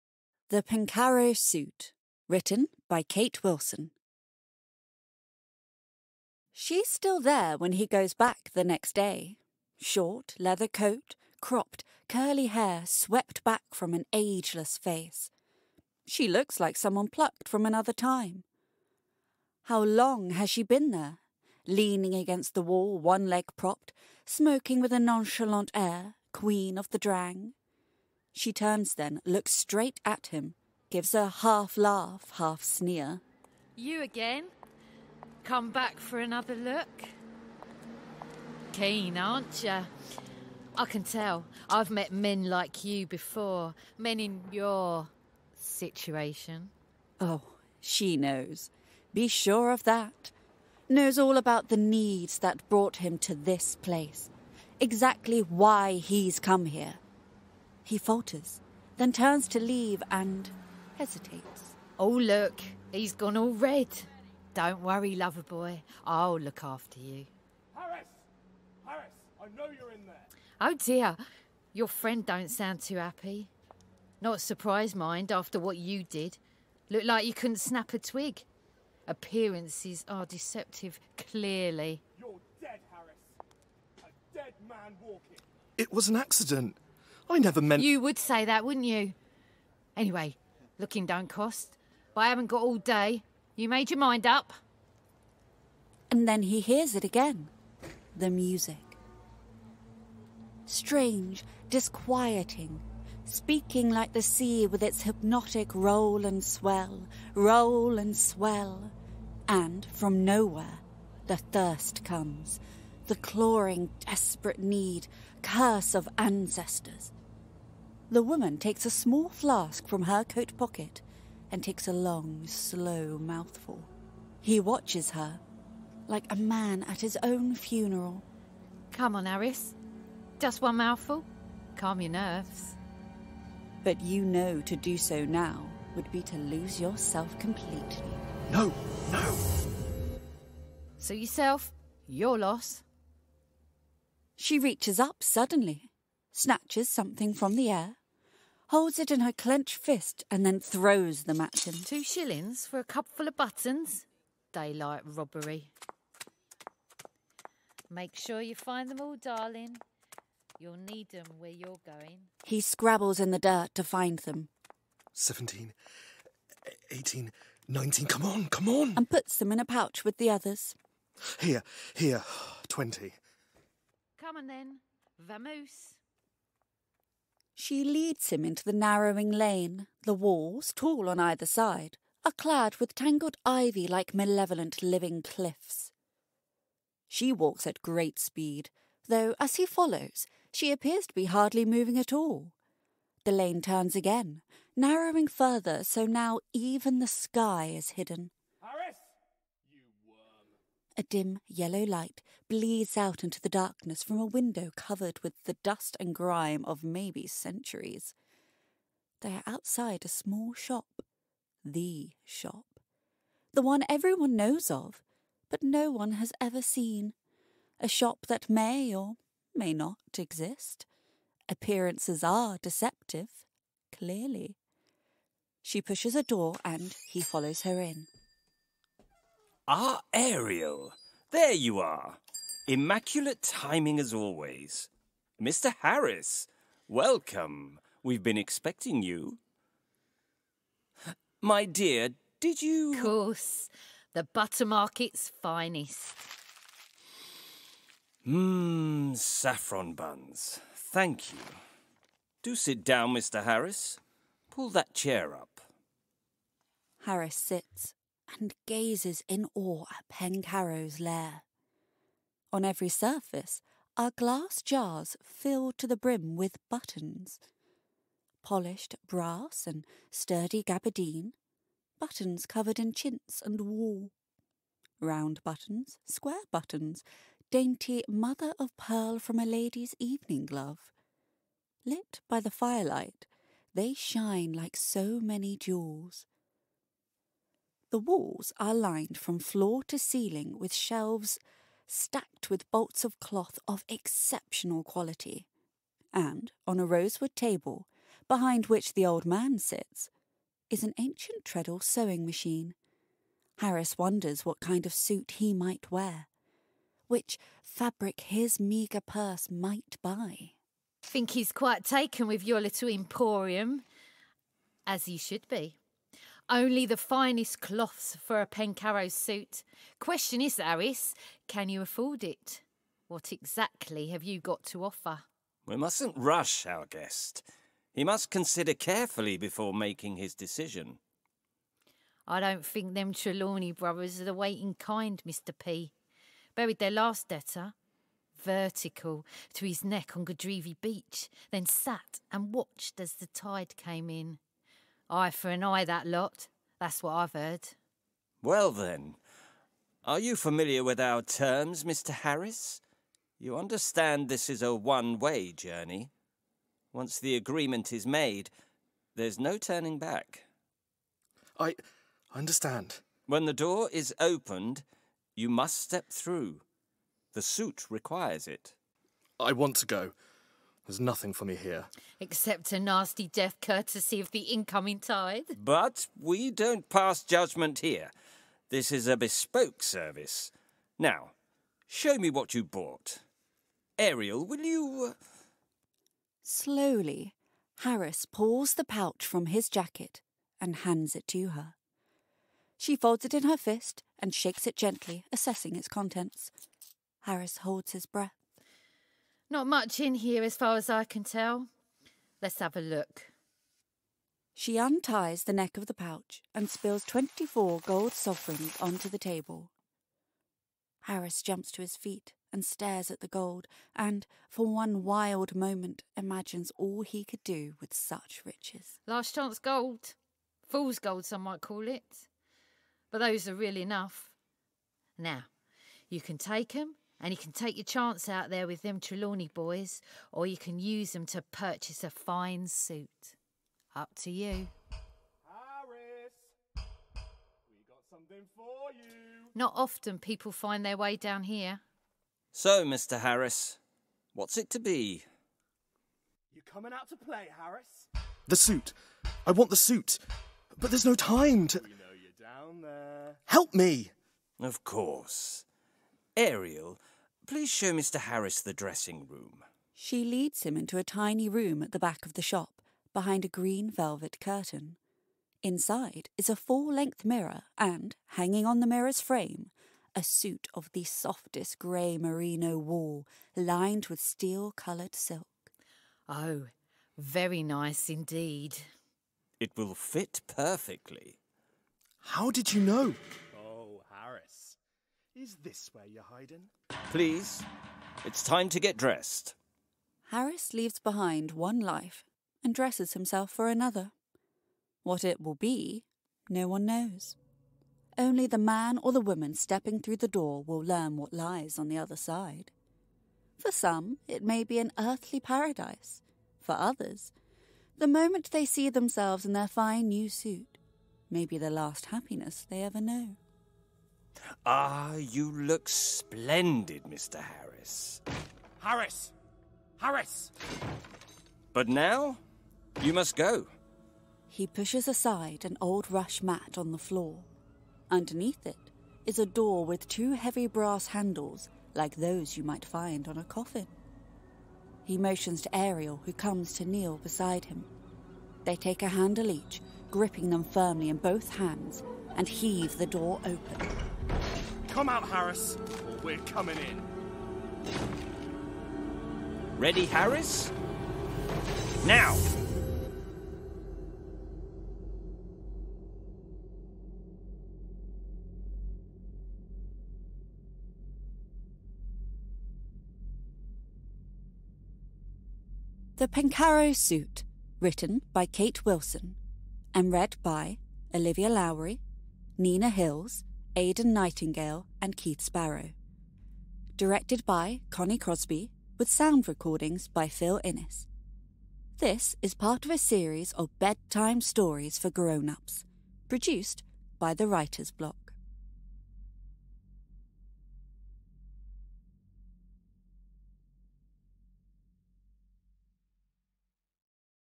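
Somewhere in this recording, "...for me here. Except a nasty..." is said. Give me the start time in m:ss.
6:11.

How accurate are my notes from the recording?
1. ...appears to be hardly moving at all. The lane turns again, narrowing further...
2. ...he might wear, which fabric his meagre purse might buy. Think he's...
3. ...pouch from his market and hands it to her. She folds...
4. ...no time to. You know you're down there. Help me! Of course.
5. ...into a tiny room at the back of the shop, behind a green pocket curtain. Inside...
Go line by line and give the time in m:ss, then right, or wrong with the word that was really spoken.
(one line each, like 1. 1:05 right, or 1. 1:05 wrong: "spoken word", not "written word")
1. 3:10 right
2. 5:05 right
3. 6:28 wrong: "jacket", not "market"
4. 7:31 right
5. 7:40 wrong: "velvet", not "pocket".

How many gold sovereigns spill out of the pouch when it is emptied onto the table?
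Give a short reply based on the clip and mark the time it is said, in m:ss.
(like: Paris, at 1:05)
24, at 6:47.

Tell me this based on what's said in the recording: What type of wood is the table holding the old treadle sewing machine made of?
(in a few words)
Rosewood.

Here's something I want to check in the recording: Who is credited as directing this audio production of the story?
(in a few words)
Connie Crosby.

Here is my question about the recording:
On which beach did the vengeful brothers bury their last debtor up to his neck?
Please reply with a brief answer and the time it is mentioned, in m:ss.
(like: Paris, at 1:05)
Godrevy Beach, at 5:40.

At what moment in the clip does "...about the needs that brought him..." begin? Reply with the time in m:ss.
0:51.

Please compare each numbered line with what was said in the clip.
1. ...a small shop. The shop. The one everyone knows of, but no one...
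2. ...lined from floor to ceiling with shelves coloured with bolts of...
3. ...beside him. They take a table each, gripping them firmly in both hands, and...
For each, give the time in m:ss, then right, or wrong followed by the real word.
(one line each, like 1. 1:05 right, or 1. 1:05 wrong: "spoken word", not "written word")
1. 3:30 right
2. 4:48 wrong: "stacked", not "coloured"
3. 8:57 wrong: "handle", not "table".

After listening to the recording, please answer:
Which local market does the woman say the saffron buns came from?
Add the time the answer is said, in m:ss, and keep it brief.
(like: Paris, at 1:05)
The butter market, at 4:04.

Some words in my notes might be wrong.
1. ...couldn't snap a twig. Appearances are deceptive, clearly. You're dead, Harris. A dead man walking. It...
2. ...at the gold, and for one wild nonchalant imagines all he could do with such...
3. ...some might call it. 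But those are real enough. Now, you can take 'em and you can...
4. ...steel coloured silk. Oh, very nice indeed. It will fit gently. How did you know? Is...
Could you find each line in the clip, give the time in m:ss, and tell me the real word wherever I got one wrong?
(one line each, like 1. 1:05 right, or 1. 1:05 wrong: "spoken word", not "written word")
1. 1:17 right
2. 6:53 wrong: "moment", not "nonchalant"
3. 7:01 right
4. 7:54 wrong: "perfectly", not "gently".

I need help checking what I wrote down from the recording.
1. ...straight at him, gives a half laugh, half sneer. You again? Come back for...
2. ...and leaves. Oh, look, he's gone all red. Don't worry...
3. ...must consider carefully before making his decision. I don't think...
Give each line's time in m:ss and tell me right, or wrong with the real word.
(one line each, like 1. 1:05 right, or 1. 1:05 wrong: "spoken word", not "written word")
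1. 0:29 right
2. 1:00 wrong: "hesitates", not "leaves"
3. 5:28 right.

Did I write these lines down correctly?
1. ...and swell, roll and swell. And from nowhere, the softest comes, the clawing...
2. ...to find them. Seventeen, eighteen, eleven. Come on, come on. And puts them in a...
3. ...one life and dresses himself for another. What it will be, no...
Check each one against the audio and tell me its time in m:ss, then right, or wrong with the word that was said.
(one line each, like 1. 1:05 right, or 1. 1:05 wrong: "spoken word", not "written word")
1. 1:46 wrong: "thirst", not "softest"
2. 2:43 wrong: "nineteen", not "eleven"
3. 8:11 right.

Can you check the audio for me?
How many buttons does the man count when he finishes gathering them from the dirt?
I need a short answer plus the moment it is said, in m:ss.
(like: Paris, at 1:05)
20, at 2:52.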